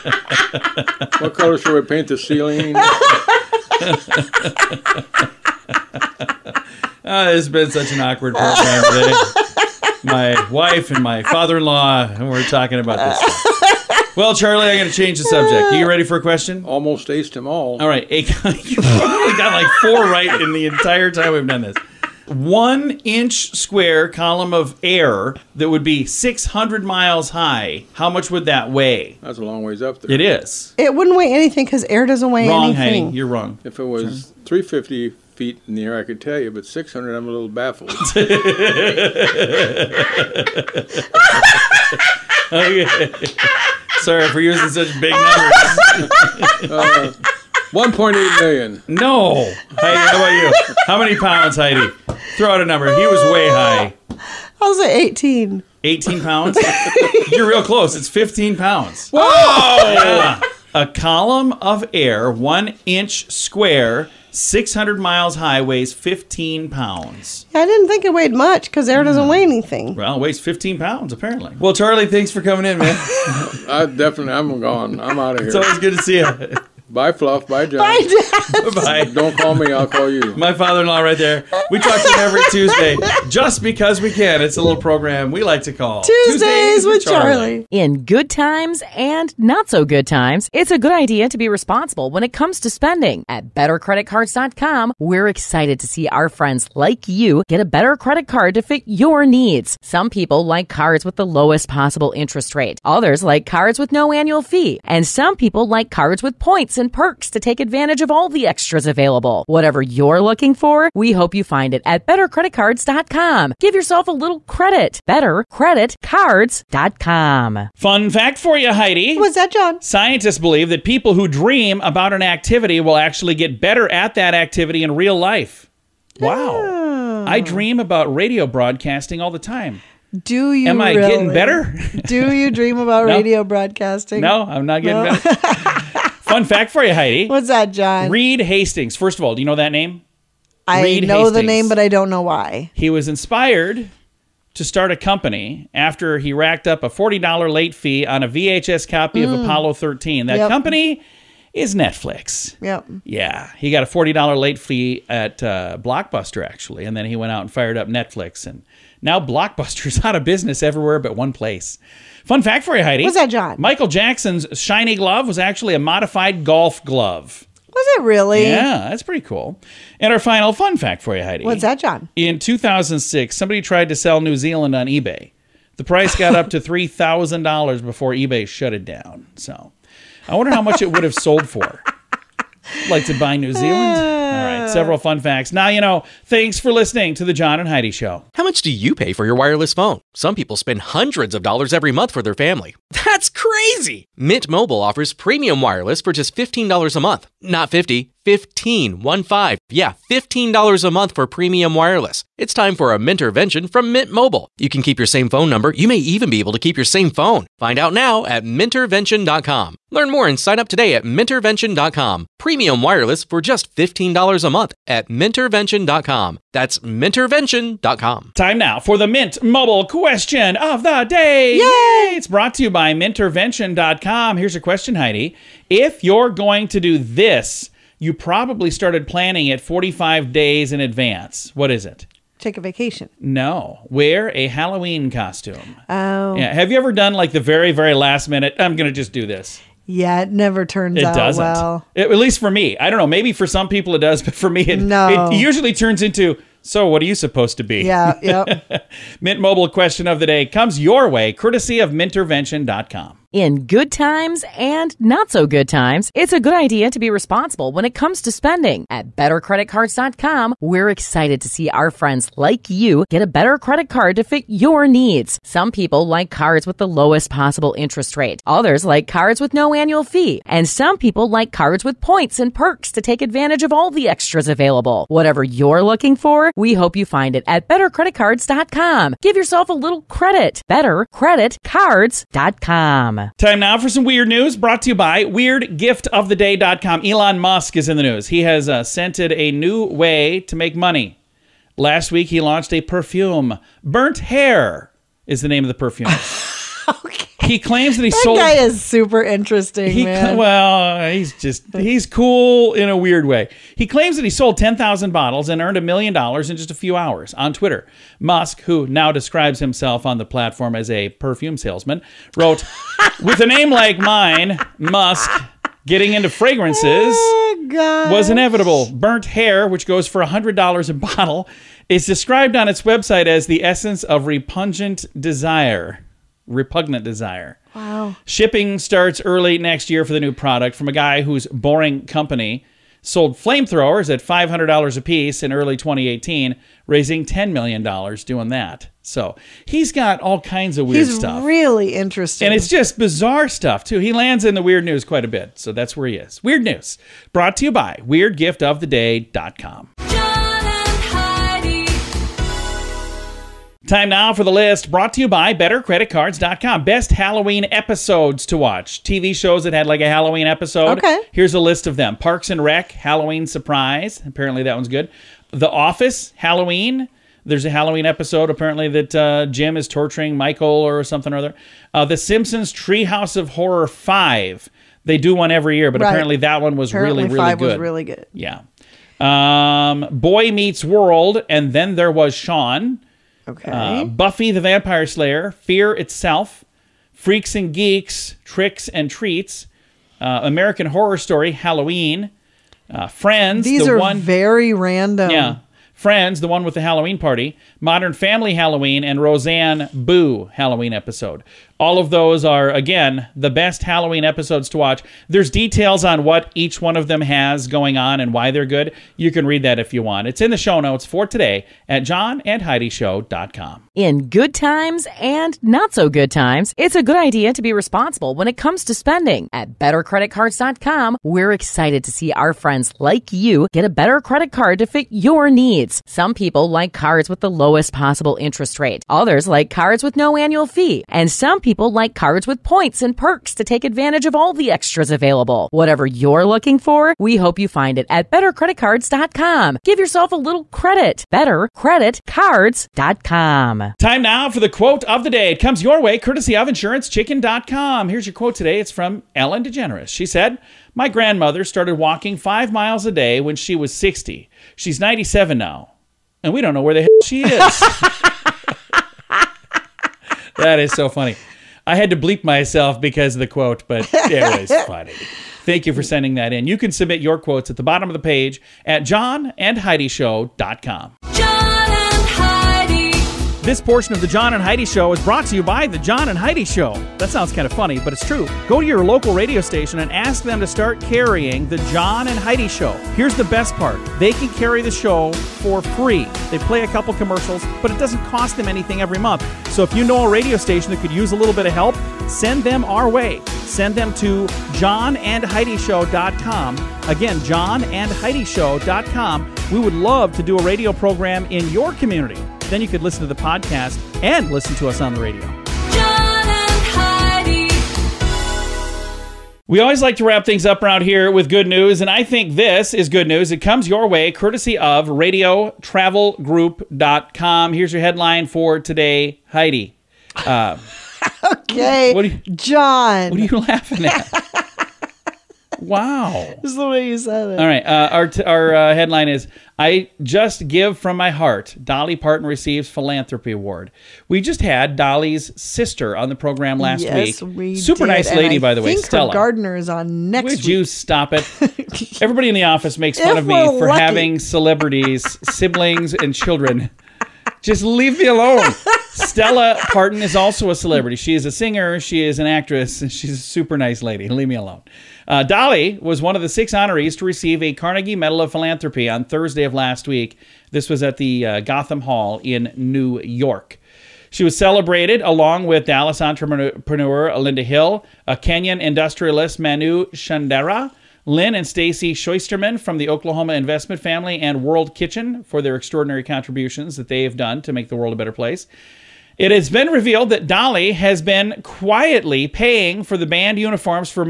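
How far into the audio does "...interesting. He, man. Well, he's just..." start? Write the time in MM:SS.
04:59.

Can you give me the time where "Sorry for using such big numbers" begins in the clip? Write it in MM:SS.
00:44.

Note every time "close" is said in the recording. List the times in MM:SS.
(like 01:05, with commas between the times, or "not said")
00:57.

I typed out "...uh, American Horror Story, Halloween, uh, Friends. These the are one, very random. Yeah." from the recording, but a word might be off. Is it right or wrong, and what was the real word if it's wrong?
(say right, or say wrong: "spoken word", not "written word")
right.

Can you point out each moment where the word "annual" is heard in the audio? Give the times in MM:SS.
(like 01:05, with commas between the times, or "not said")
01:44, 04:29, 07:10.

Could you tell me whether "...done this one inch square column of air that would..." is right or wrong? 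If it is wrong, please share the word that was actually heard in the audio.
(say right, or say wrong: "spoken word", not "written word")
right.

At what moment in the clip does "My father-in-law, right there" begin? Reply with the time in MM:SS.
01:20.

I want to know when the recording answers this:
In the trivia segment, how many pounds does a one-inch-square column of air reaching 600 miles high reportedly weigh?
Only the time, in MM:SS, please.
00:57.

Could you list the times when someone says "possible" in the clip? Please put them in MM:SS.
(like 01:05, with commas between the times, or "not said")
01:41, 04:27, 07:07.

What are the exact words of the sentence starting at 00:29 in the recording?
That's a long ways up there.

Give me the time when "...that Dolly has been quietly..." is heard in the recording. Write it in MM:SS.
09:40.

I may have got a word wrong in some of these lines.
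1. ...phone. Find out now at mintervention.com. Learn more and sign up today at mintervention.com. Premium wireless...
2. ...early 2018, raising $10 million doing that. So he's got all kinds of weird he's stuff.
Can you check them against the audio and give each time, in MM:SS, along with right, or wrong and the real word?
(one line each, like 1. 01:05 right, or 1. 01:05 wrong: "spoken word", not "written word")
1. 03:27 right
2. 05:35 right.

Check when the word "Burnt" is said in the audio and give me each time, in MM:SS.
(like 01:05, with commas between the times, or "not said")
04:53, 05:18.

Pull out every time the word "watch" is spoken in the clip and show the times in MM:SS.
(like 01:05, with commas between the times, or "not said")
05:58, 06:44.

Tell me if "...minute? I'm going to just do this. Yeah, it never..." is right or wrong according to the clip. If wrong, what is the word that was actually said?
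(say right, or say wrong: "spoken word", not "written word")
right.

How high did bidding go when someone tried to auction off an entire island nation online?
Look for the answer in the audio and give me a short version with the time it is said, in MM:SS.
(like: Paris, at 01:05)
$3,000, at 02:56.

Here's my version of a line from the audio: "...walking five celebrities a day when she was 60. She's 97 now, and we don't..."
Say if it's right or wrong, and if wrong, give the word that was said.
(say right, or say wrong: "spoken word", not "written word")
wrong: "miles", not "celebrities".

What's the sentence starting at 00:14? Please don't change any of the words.
Well, Charlie, I'm going to change the subject.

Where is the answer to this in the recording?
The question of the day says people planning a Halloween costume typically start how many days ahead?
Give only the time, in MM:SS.
03:49.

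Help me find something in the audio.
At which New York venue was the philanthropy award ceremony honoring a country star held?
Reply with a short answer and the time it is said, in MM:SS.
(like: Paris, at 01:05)
Gotham Hall, at 09:21.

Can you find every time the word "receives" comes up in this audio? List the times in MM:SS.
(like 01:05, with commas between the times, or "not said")
08:52, 09:17.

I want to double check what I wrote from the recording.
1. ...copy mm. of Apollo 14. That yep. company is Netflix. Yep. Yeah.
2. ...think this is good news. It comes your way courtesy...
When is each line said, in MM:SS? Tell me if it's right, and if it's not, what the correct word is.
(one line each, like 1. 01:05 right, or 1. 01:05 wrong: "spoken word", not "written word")
1. 02:28 wrong: "13", not "14"
2. 08:32 right.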